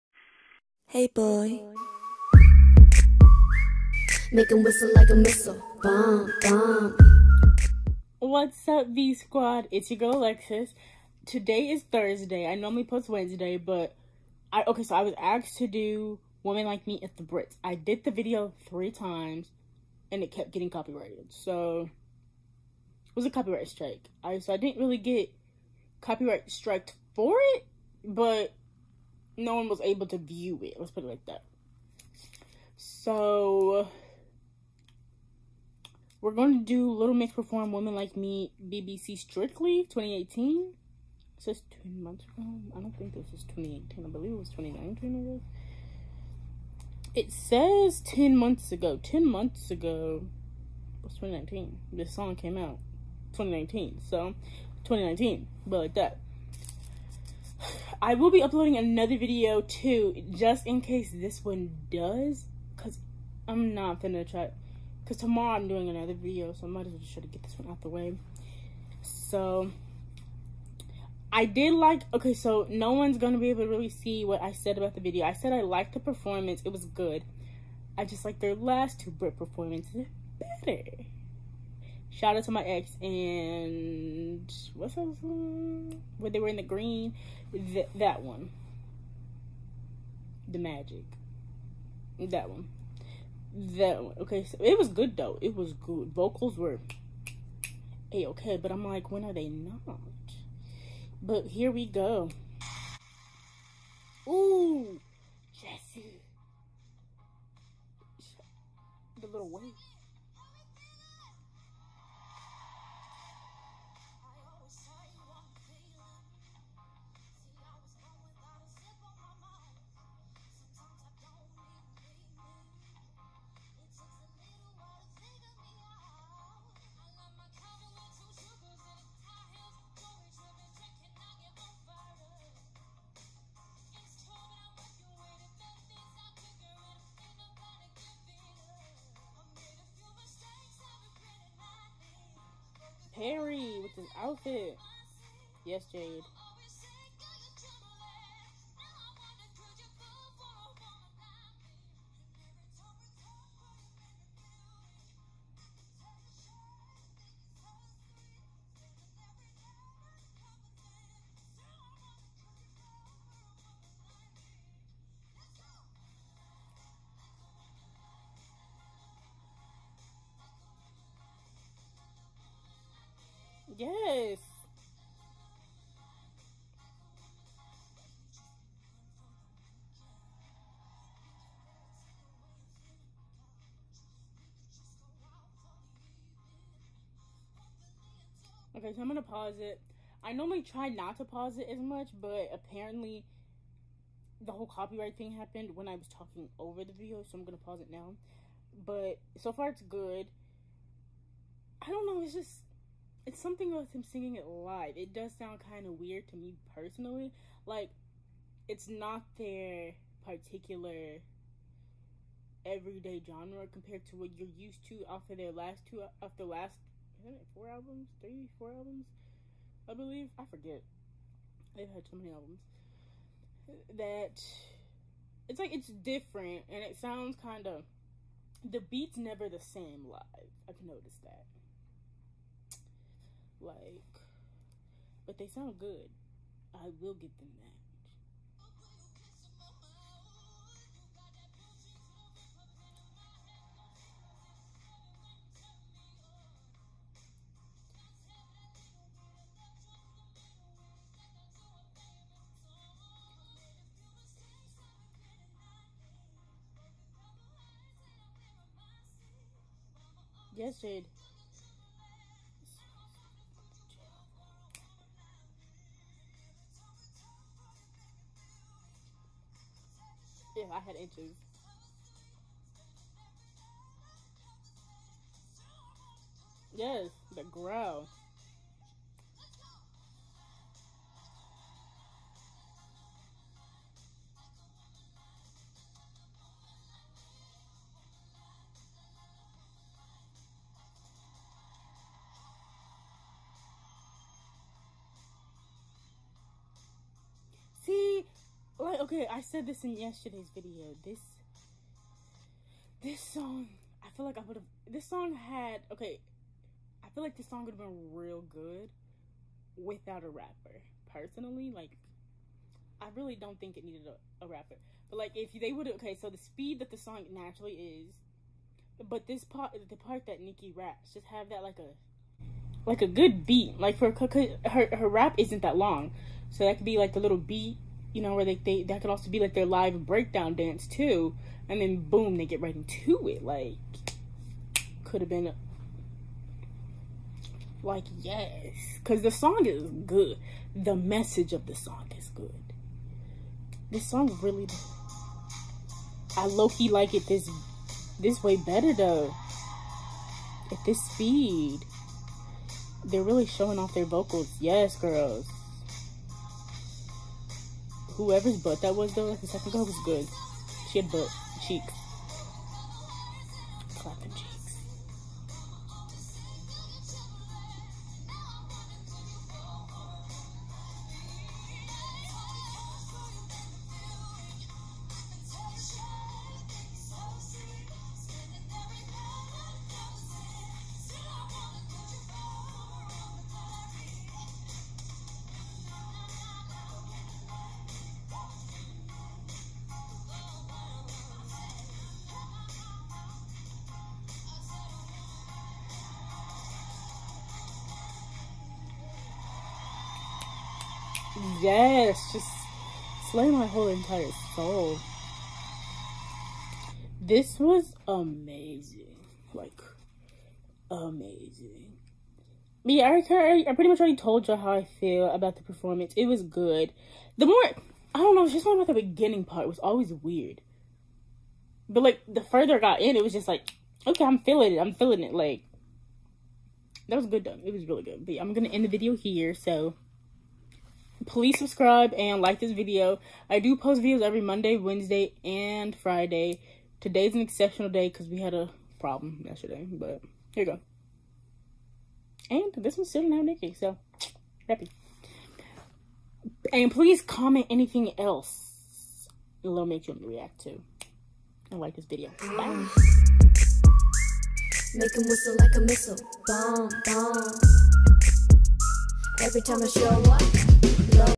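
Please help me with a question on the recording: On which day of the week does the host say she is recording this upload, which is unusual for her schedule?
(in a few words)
Thursday.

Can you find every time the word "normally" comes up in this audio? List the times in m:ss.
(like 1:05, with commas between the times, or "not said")
0:12, 3:10.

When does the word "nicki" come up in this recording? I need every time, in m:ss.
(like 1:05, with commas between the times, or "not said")
5:20, 7:23.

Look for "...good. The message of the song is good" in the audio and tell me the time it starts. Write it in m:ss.
5:40.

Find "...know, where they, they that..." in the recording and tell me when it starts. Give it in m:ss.
5:28.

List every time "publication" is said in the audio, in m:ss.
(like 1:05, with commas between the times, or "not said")
not said.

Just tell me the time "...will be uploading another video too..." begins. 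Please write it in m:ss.
0:58.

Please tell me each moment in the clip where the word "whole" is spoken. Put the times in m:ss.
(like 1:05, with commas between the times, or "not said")
3:14, 6:43.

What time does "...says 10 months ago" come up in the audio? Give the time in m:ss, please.
0:47.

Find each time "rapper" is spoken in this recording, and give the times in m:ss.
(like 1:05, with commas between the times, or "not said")
5:10, 5:14.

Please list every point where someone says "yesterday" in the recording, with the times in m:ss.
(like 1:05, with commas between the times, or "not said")
4:59, 7:19.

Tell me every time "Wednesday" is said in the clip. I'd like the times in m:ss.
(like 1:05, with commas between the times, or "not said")
0:13, 7:14.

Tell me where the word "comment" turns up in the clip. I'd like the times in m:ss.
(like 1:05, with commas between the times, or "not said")
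7:27.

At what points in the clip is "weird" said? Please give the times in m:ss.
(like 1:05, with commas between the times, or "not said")
3:25, 7:00.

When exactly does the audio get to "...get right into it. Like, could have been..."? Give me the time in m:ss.
5:32.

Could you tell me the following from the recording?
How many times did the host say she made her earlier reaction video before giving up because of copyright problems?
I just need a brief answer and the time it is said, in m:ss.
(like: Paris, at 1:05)
3, at 0:18.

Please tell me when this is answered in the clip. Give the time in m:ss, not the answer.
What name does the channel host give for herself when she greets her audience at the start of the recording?
0:10.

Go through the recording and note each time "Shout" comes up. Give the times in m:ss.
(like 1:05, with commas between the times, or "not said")
1:22.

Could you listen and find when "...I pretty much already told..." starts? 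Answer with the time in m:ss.
6:53.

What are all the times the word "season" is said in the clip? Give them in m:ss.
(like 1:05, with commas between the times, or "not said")
not said.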